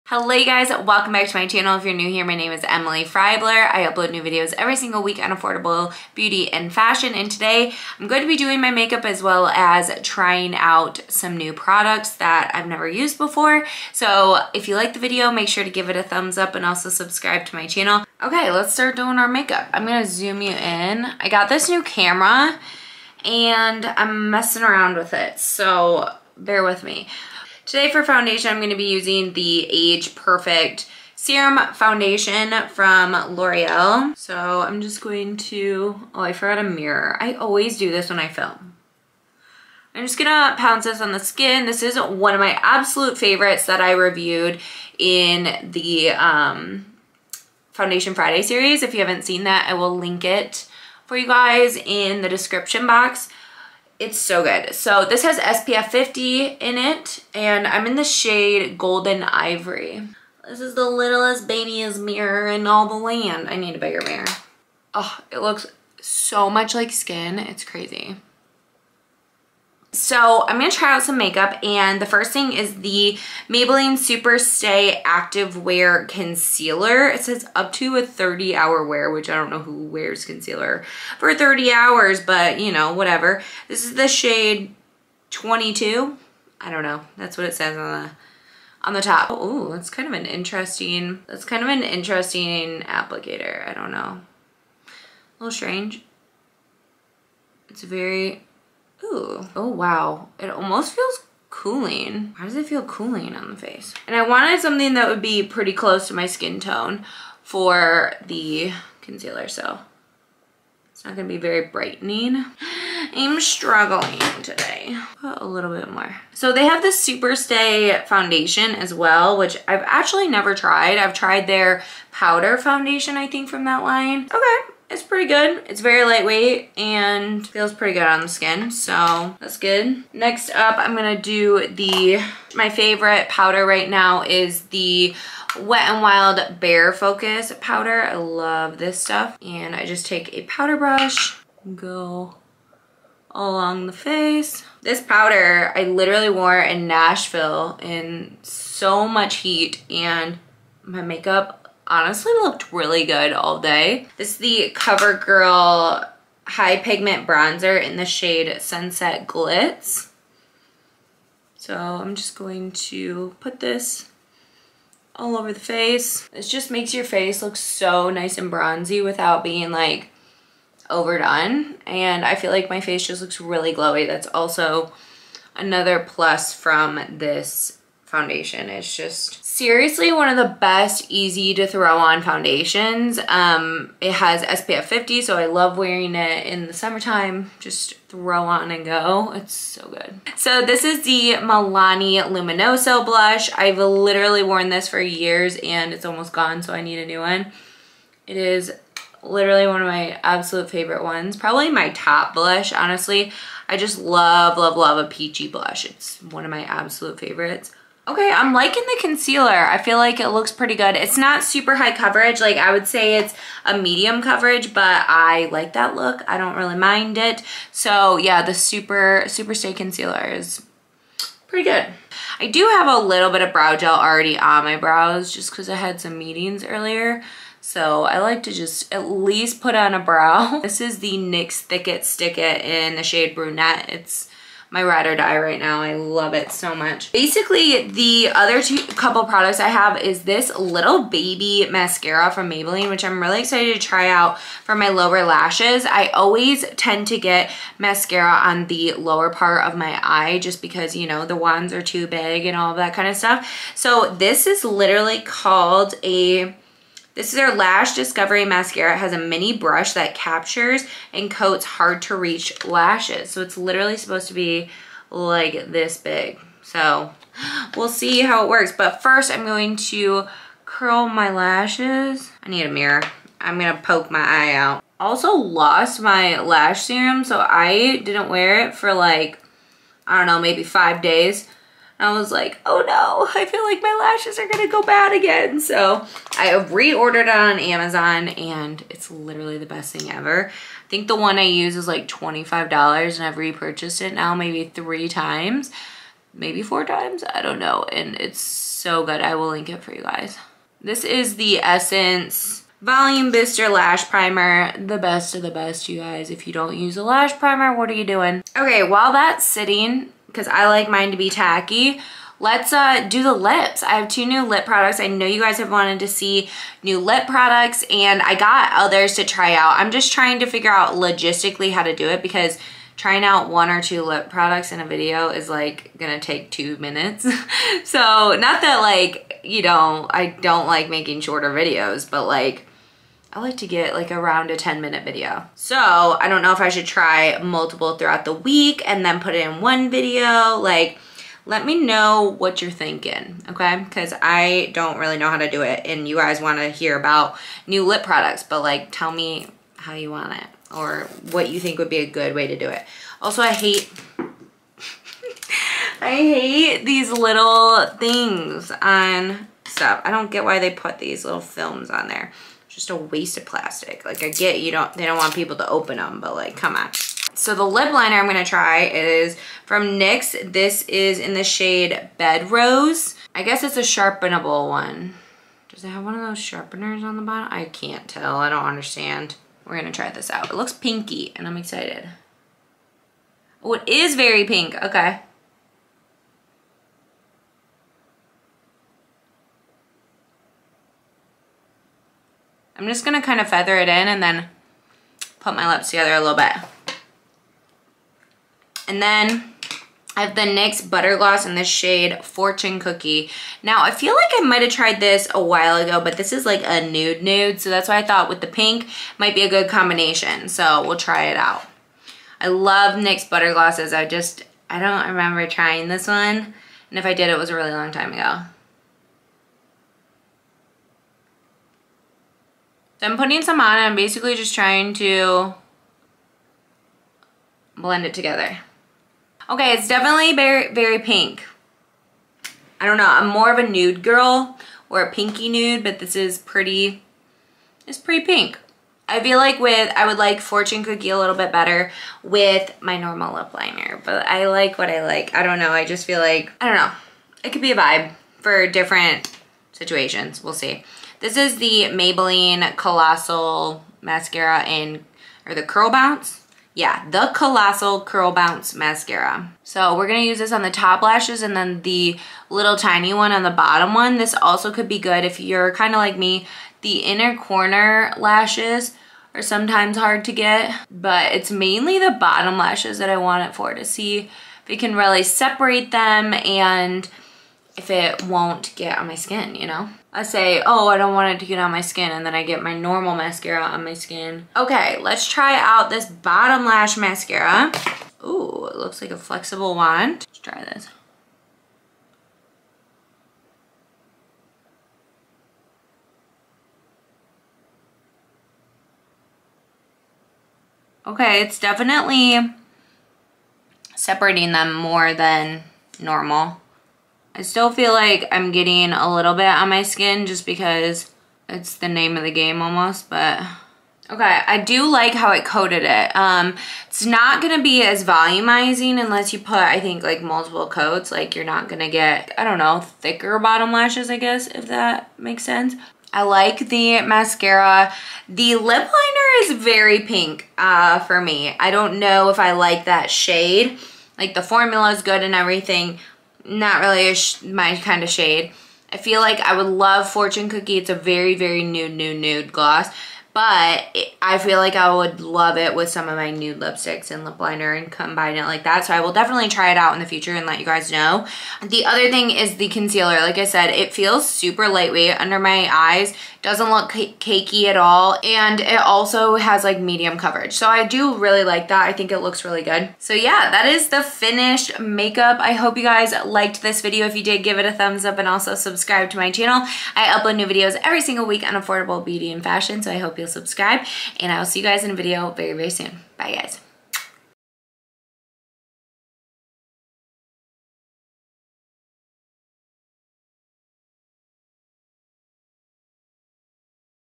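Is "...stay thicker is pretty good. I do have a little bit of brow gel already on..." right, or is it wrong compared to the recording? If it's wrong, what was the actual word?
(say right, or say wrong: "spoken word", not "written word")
wrong: "concealer", not "thicker".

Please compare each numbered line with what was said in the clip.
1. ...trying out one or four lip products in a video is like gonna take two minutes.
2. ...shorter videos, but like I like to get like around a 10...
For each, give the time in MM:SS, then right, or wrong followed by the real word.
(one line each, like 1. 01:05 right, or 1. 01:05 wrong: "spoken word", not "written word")
1. 05:22 wrong: "two", not "four"
2. 05:31 right.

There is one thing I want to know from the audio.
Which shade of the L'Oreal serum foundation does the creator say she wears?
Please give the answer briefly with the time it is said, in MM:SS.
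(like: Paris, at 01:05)
Golden Ivory, at 00:58.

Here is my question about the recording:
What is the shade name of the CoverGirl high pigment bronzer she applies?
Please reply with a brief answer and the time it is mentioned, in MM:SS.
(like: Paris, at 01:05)
Sunset Glitz, at 02:38.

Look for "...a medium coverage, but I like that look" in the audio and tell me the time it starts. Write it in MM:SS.
03:33.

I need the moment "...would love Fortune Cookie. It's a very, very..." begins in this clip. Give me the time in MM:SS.
08:59.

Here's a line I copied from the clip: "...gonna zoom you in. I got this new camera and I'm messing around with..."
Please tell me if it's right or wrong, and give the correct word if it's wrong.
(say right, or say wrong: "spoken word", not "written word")
right.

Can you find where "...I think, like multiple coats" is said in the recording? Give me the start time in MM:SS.
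08:39.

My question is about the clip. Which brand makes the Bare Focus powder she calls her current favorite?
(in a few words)
Wet n Wild.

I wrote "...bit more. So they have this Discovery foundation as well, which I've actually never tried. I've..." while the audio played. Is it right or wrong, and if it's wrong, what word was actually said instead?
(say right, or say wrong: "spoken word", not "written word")
wrong: "Superstay", not "Discovery".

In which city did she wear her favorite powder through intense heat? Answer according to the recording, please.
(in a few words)
Nashville.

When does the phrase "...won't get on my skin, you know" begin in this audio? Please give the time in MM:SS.
07:58.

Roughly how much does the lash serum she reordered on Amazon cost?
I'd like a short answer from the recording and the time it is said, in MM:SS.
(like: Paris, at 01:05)
$25, at 04:52.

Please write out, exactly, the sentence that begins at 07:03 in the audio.
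So I'm putting some on I'm basically just trying to blend it together.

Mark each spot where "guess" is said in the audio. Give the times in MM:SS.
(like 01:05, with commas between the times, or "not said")
06:13, 08:44.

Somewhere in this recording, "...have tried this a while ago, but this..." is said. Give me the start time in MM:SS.
06:44.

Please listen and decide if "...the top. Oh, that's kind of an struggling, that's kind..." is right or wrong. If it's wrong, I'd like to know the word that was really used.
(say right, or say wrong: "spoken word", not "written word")
wrong: "interesting", not "struggling".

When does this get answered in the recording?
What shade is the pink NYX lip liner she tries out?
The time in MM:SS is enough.
06:12.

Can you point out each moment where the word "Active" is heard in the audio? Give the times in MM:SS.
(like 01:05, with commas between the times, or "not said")
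01:15.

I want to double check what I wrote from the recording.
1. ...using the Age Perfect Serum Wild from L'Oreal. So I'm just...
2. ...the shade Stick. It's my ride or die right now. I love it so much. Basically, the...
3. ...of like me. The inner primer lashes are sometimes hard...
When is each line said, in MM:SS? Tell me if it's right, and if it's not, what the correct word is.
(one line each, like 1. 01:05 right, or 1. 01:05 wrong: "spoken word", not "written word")
1. 00:28 wrong: "Foundation", not "Wild"
2. 03:52 wrong: "Brunette", not "Stick"
3. 07:45 wrong: "corner", not "primer".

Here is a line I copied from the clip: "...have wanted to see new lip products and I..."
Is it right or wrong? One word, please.
right.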